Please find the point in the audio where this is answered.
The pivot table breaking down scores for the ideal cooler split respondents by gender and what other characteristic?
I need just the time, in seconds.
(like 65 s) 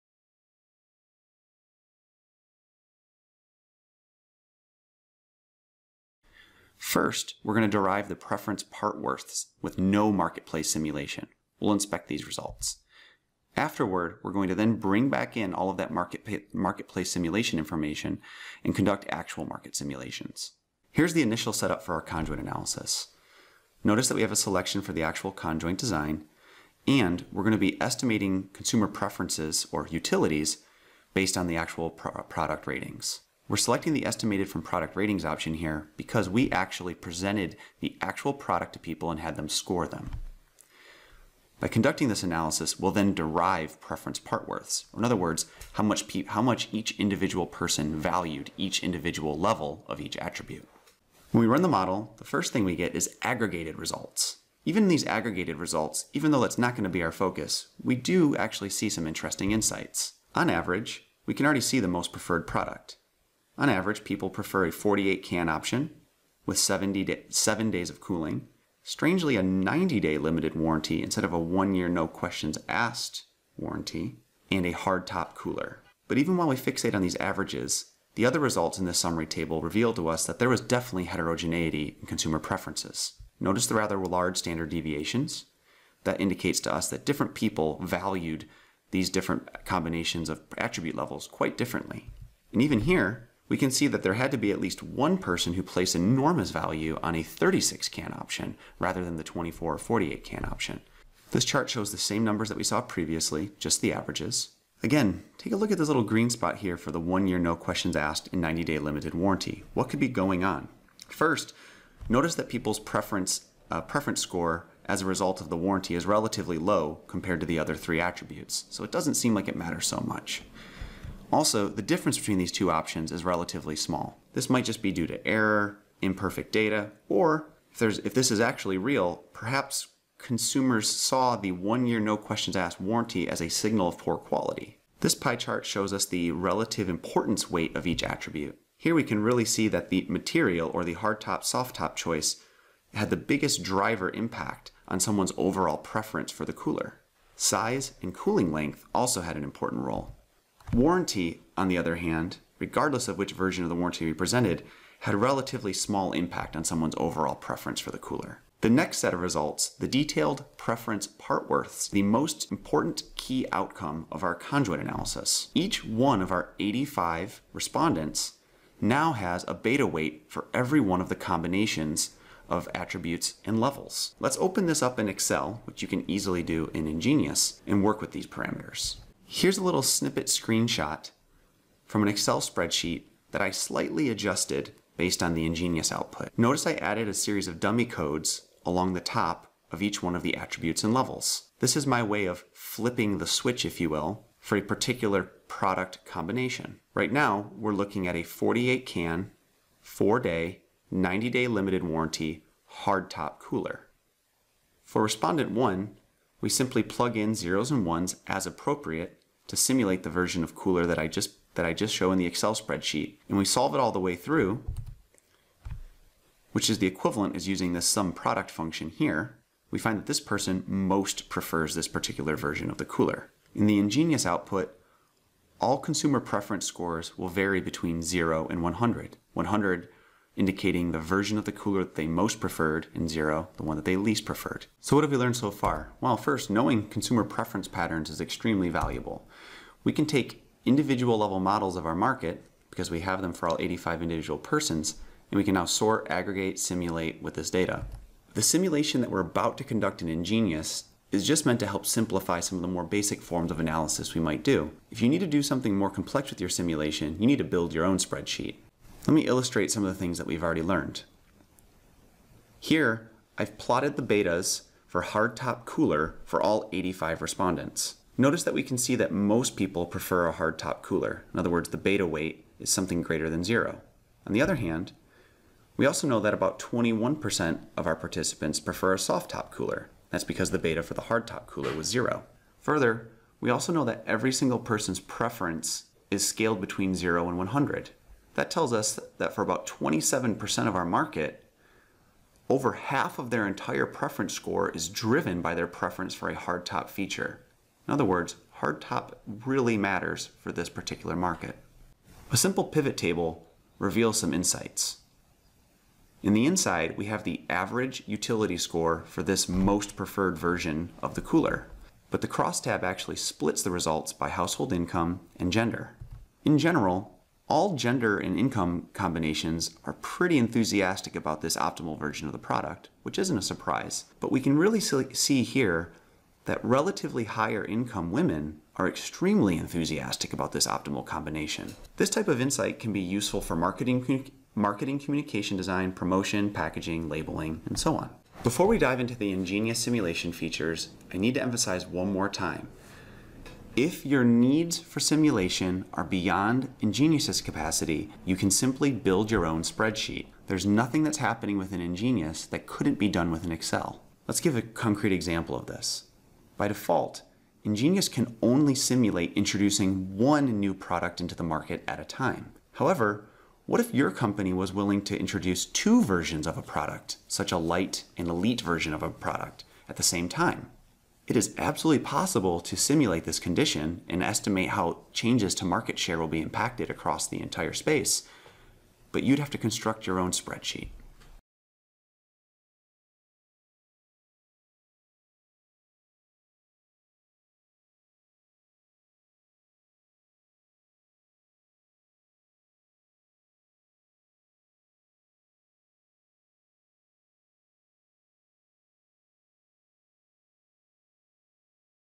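314 s.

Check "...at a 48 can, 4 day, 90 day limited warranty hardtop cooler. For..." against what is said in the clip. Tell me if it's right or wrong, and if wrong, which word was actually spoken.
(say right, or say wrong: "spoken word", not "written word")
right.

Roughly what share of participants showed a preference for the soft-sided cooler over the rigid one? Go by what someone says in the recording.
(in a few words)
21%.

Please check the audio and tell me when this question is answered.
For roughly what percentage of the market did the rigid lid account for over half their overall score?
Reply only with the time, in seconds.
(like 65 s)
289 s.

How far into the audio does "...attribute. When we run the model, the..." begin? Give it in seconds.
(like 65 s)
50 s.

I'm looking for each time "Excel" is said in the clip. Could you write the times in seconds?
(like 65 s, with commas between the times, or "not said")
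175 s, 182 s, 212 s, 353 s.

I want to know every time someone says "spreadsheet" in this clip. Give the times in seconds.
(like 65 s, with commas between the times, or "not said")
182 s, 212 s, 257 s, 349 s, 380 s.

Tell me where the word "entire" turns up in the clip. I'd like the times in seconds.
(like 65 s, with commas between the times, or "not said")
293 s, 377 s.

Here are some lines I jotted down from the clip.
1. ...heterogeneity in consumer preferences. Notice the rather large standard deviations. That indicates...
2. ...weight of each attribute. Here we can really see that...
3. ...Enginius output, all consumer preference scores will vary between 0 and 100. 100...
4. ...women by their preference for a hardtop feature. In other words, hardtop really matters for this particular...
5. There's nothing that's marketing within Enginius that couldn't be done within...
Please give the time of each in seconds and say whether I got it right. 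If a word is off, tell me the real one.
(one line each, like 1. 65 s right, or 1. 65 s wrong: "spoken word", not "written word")
1. 81 s right
2. 137 s right
3. 223 s right
4. 294 s wrong: "driven", not "women"
5. 350 s wrong: "happening", not "marketing".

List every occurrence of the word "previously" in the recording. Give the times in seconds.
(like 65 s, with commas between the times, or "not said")
102 s.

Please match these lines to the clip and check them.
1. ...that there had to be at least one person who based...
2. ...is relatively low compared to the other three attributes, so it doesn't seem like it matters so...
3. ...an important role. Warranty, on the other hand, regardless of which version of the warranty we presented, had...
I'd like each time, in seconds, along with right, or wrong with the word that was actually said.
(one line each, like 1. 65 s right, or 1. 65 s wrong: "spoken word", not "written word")
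1. 93 s wrong: "placed", not "based"
2. 115 s right
3. 149 s right.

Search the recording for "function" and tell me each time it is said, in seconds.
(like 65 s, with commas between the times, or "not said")
218 s.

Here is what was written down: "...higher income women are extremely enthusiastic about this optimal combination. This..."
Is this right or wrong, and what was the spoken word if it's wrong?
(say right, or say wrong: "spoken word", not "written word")
right.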